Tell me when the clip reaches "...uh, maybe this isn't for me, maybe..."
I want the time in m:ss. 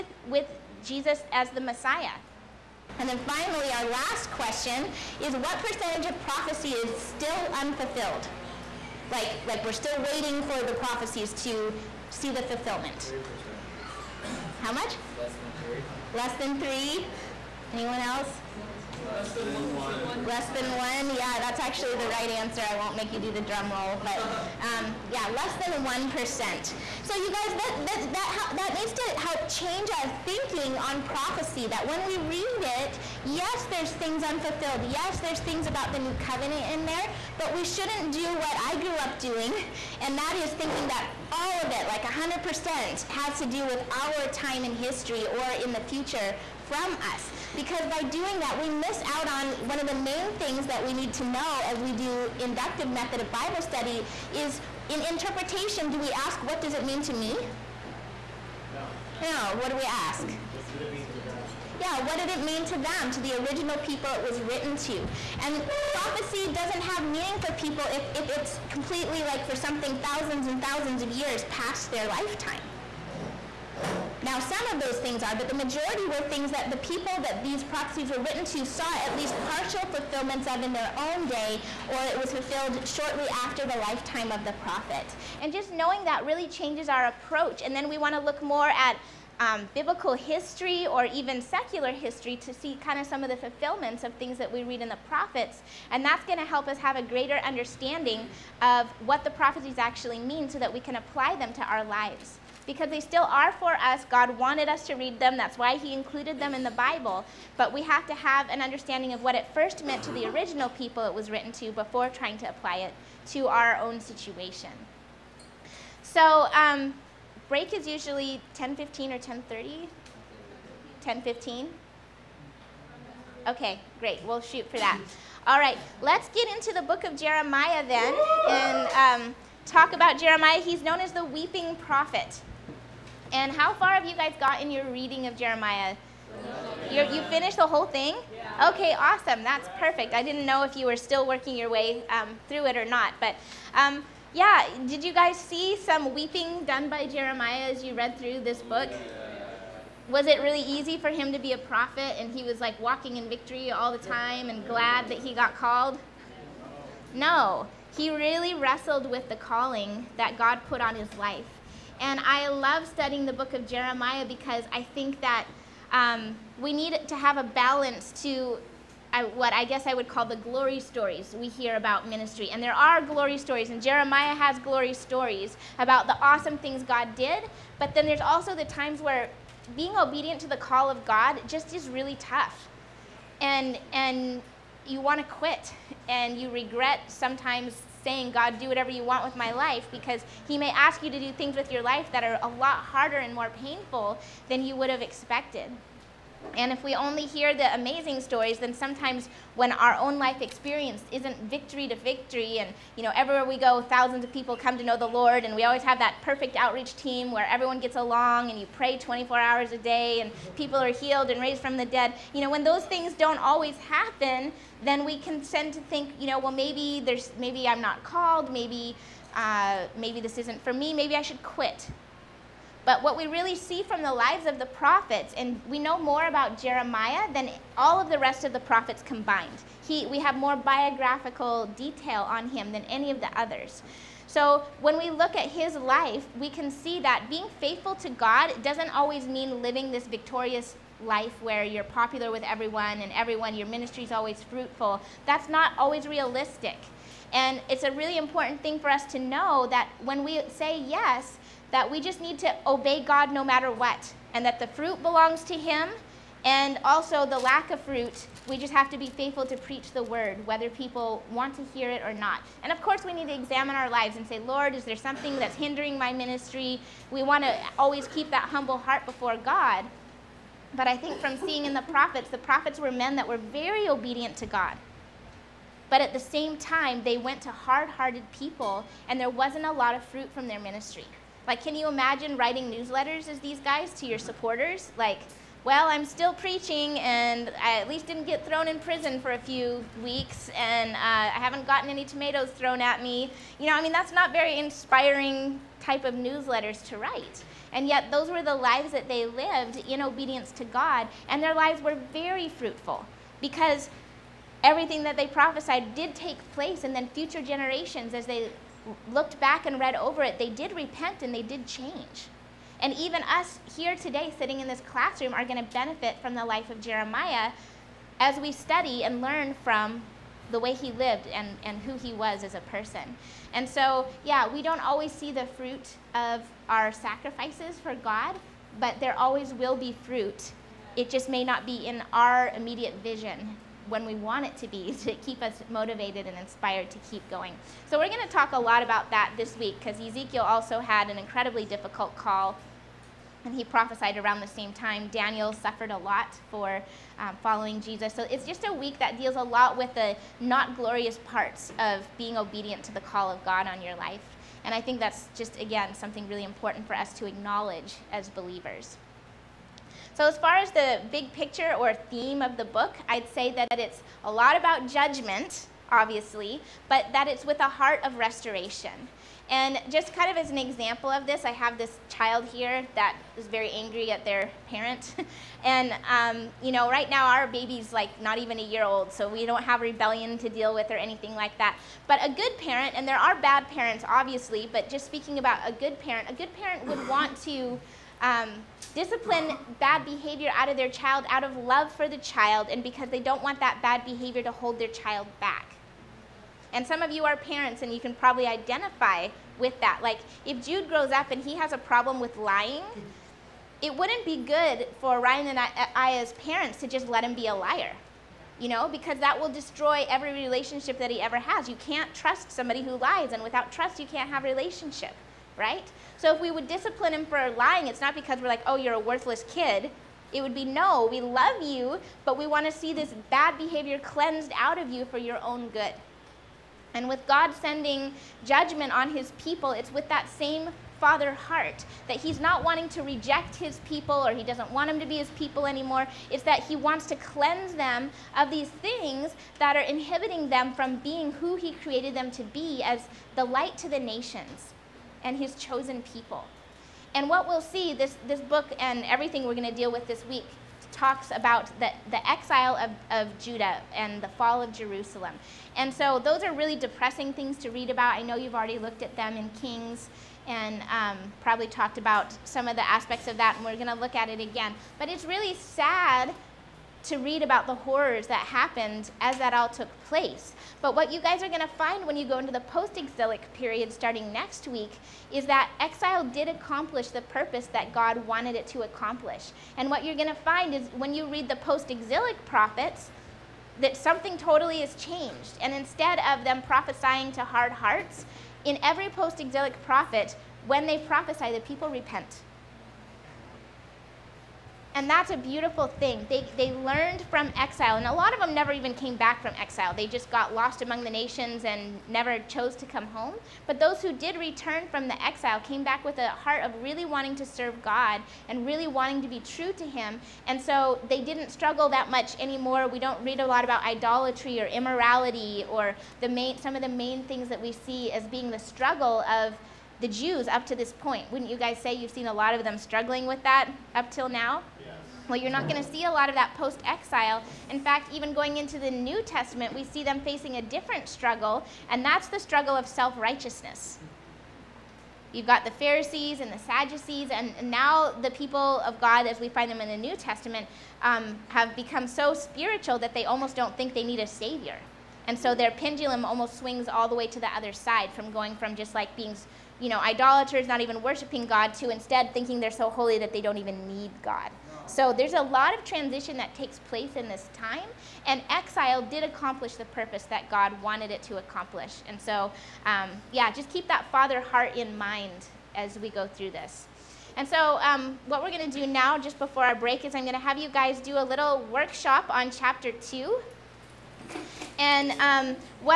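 3:39.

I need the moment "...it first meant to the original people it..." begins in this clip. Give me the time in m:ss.
1:49.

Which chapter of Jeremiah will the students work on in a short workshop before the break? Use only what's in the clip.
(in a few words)
chapter 2.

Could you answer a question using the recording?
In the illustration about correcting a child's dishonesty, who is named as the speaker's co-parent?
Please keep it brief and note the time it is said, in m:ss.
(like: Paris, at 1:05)
Ryan, at 6:45.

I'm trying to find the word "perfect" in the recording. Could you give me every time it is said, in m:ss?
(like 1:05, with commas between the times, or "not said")
2:19, 3:26.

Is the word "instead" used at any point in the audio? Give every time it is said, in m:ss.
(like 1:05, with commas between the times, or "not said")
8:05, 9:11.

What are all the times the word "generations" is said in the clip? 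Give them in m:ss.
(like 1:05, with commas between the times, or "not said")
5:07.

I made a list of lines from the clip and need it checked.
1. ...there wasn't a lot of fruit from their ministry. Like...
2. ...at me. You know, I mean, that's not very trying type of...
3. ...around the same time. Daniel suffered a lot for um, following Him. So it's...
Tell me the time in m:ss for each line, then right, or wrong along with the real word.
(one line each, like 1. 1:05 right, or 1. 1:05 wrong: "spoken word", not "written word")
1. 4:39 right
2. 4:52 wrong: "inspiring", not "trying"
3. 5:44 wrong: "Jesus", not "Him".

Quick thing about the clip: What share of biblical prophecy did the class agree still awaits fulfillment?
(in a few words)
less than 1%.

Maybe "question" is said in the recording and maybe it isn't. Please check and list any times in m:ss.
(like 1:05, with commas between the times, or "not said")
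0:04.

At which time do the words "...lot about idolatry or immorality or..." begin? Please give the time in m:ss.
8:33.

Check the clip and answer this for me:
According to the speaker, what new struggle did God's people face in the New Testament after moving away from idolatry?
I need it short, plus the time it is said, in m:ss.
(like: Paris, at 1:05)
self righteousness, at 8:52.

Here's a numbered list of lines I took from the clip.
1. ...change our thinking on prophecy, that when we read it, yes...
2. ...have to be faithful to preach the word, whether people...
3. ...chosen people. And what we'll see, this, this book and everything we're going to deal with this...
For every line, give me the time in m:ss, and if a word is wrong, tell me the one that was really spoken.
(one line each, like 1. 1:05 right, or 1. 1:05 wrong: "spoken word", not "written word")
1. 0:29 right
2. 4:18 right
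3. 7:25 right.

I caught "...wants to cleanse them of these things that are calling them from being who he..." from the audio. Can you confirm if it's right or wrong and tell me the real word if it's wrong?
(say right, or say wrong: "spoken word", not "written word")
wrong: "inhibiting", not "calling".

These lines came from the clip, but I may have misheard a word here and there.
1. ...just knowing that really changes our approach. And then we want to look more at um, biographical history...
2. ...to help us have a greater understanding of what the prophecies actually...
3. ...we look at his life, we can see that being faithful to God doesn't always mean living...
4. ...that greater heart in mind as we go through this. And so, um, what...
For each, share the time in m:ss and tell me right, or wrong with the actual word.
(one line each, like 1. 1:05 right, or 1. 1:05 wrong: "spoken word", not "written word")
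1. 1:25 wrong: "biblical", not "biographical"
2. 1:36 right
3. 3:54 right
4. 9:23 wrong: "father", not "greater".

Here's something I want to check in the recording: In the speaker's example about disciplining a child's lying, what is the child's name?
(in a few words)
Jude.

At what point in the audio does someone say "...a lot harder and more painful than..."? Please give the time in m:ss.
3:12.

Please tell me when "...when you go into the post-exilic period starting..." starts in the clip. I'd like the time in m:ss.
7:52.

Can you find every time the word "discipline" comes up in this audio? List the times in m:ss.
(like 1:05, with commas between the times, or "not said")
6:28, 6:56.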